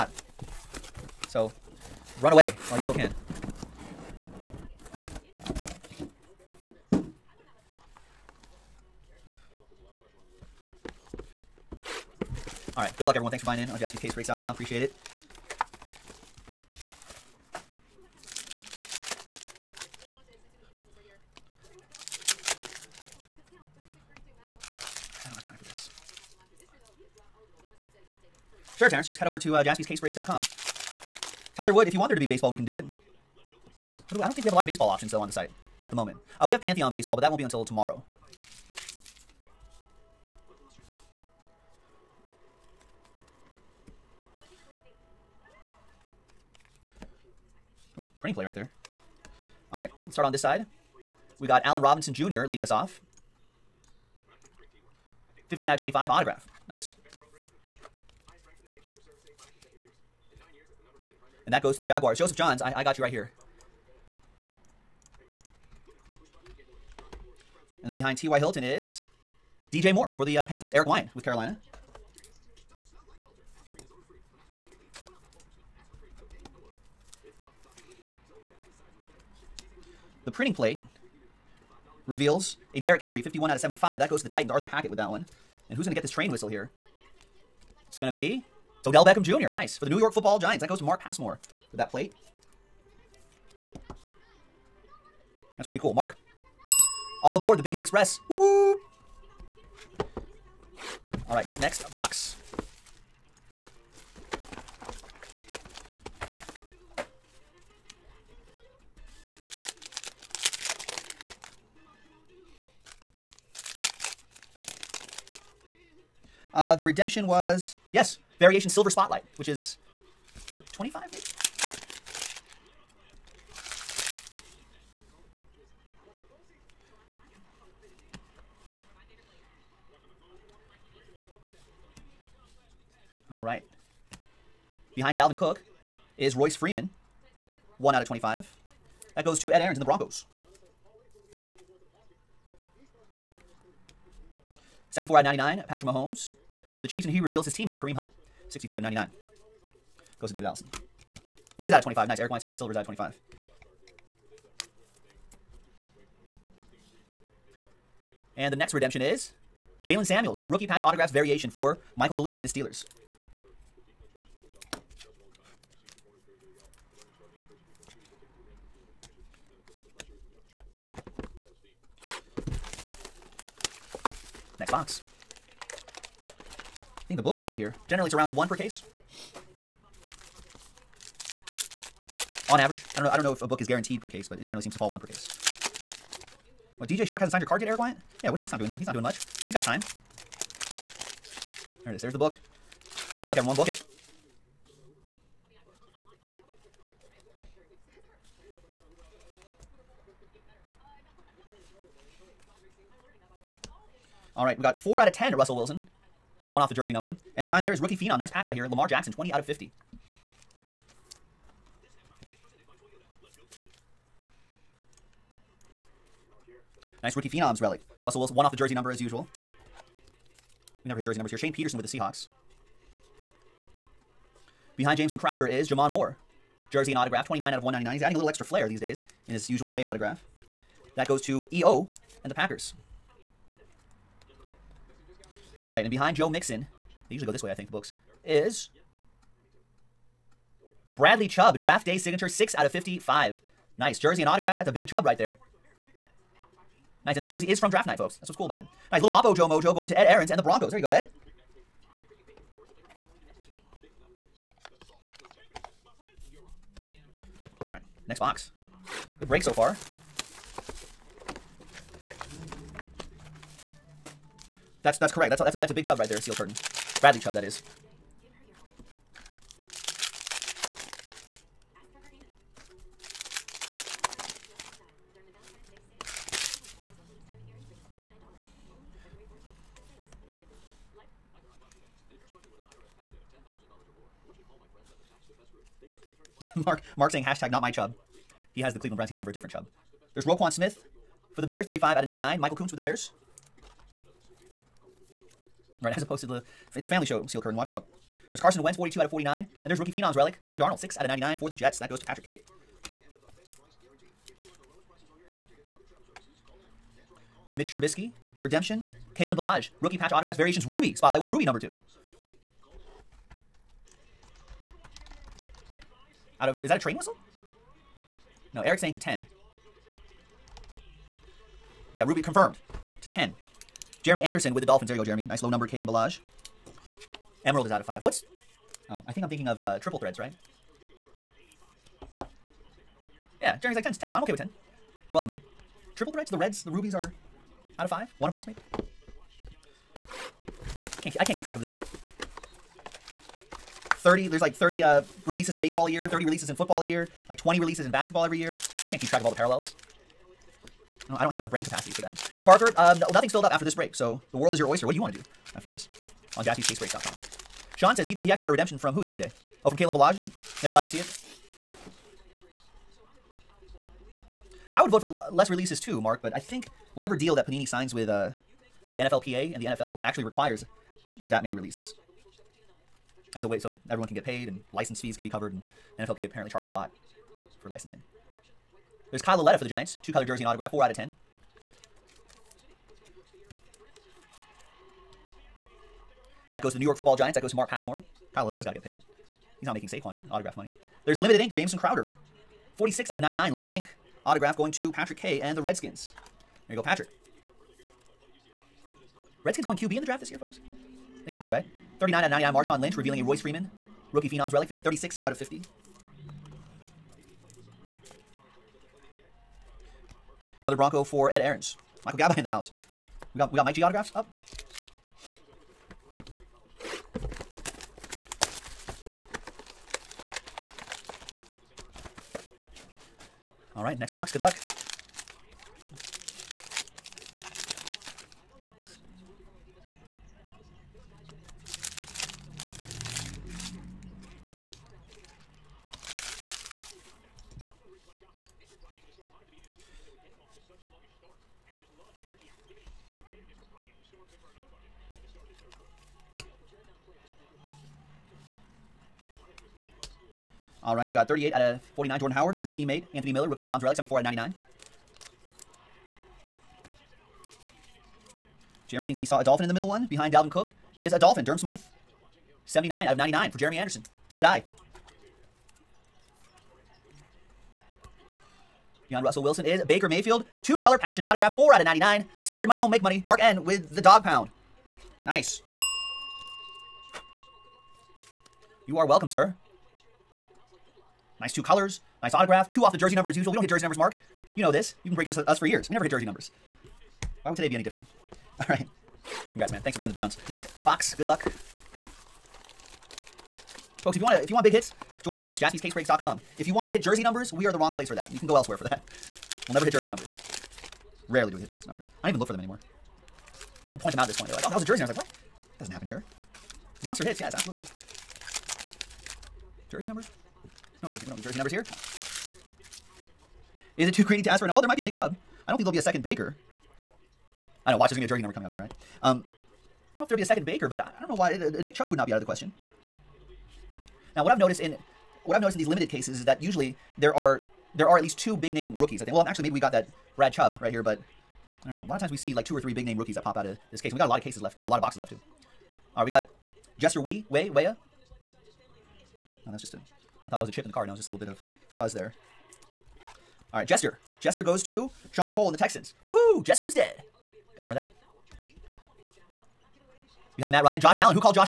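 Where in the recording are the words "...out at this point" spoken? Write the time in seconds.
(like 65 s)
504 s.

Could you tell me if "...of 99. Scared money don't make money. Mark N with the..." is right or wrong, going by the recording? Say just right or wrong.
right.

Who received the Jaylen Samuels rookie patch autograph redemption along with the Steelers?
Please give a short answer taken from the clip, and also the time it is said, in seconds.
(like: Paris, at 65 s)
Michael Gallucci, at 161 s.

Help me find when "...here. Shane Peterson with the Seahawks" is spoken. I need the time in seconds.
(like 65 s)
221 s.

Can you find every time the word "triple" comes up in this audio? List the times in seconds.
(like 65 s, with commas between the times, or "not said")
329 s, 335 s.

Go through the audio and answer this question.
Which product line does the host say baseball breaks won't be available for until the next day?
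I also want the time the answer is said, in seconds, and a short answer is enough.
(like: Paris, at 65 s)
Pantheon, at 36 s.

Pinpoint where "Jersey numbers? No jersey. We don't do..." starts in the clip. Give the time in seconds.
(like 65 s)
509 s.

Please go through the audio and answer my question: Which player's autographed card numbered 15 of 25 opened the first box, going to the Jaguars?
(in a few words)
Allen Robinson Jr.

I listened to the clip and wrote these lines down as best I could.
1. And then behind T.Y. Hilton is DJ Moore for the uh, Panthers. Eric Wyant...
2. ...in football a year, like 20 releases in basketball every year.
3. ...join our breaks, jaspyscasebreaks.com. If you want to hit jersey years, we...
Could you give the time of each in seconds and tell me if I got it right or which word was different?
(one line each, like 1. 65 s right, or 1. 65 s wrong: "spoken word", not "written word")
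1. 67 s right
2. 346 s right
3. 495 s wrong: "numbers", not "years".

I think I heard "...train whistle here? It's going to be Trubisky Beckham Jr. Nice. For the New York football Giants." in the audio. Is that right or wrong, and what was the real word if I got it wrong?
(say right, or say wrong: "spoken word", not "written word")
wrong: "Odell", not "Trubisky".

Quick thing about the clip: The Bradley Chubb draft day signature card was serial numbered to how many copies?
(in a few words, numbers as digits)
55.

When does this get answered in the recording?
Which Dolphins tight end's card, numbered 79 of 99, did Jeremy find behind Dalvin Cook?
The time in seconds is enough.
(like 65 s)
461 s.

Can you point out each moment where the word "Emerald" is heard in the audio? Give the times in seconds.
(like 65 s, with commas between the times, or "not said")
327 s.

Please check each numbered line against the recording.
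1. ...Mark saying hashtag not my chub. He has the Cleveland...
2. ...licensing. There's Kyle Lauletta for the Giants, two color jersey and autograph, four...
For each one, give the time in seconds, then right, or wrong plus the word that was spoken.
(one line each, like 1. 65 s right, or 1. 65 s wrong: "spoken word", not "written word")
1. 286 s right
2. 377 s right.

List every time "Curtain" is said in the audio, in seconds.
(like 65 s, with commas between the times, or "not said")
266 s, 297 s.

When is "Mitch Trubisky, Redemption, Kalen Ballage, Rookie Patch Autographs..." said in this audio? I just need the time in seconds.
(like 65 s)
307 s.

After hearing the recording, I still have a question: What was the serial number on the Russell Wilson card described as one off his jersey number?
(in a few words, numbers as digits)
4 out of 10.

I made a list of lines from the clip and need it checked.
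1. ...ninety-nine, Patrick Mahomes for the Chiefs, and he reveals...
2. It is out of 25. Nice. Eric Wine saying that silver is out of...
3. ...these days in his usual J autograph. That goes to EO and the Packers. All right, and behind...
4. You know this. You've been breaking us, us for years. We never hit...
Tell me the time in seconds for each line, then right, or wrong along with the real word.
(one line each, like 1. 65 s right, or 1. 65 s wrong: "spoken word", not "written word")
1. 145 s right
2. 151 s right
3. 228 s right
4. 484 s right.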